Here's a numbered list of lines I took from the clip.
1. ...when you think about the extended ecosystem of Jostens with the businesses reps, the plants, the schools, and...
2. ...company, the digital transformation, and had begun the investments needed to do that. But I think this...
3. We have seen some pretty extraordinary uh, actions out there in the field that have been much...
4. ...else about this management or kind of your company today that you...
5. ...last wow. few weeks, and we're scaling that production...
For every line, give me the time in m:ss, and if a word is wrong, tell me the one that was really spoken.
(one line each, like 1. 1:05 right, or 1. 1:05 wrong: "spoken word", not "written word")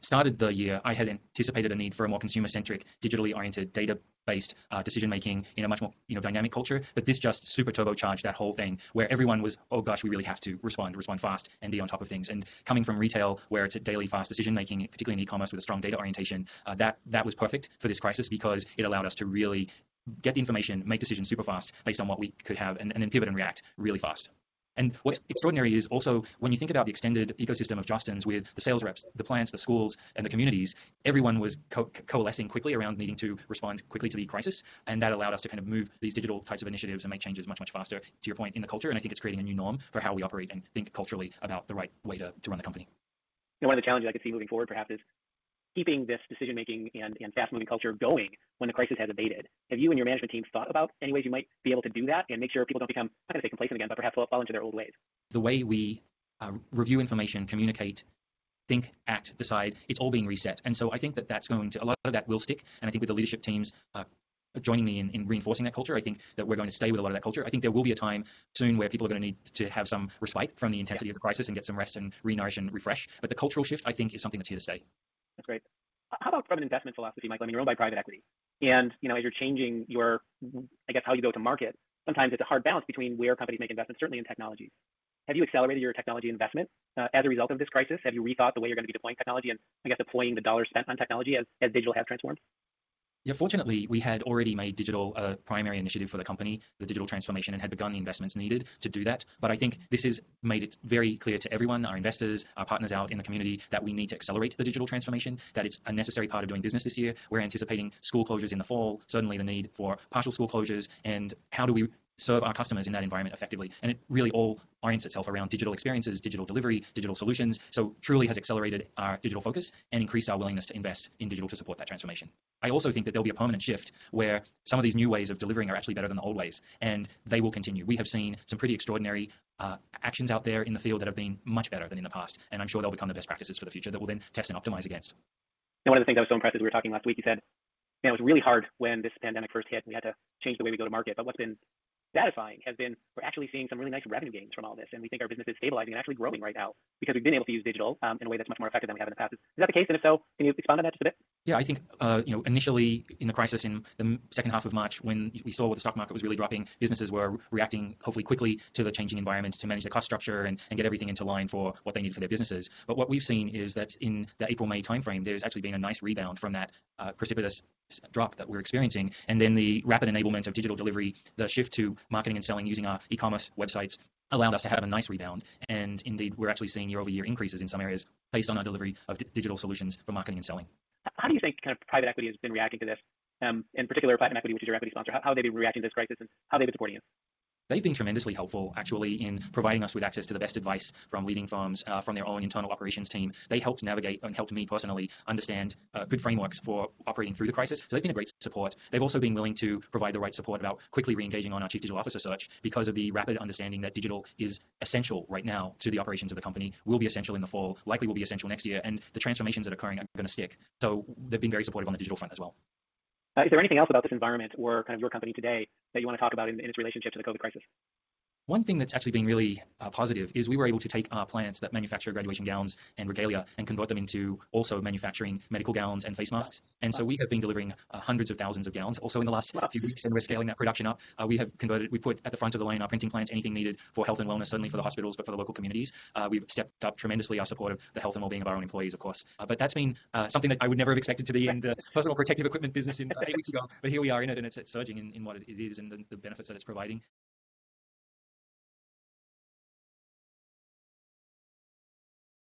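1. 0:26 wrong: "sales", not "businesses"
2. 1:36 right
3. 2:07 right
4. 3:33 wrong: "environment", not "management"
5. 3:49 right.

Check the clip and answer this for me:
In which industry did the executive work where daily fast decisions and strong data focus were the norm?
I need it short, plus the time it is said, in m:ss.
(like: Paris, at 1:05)
Retail, at 0:12.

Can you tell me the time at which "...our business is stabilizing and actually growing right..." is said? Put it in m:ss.
2:25.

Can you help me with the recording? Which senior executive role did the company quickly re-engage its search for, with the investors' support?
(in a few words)
Chief Digital Officer.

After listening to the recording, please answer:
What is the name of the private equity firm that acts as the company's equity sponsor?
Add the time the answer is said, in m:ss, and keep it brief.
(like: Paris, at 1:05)
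Platinum Equity, at 3:04.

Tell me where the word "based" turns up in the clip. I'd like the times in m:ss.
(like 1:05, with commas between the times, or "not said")
0:04, 0:21, 2:58.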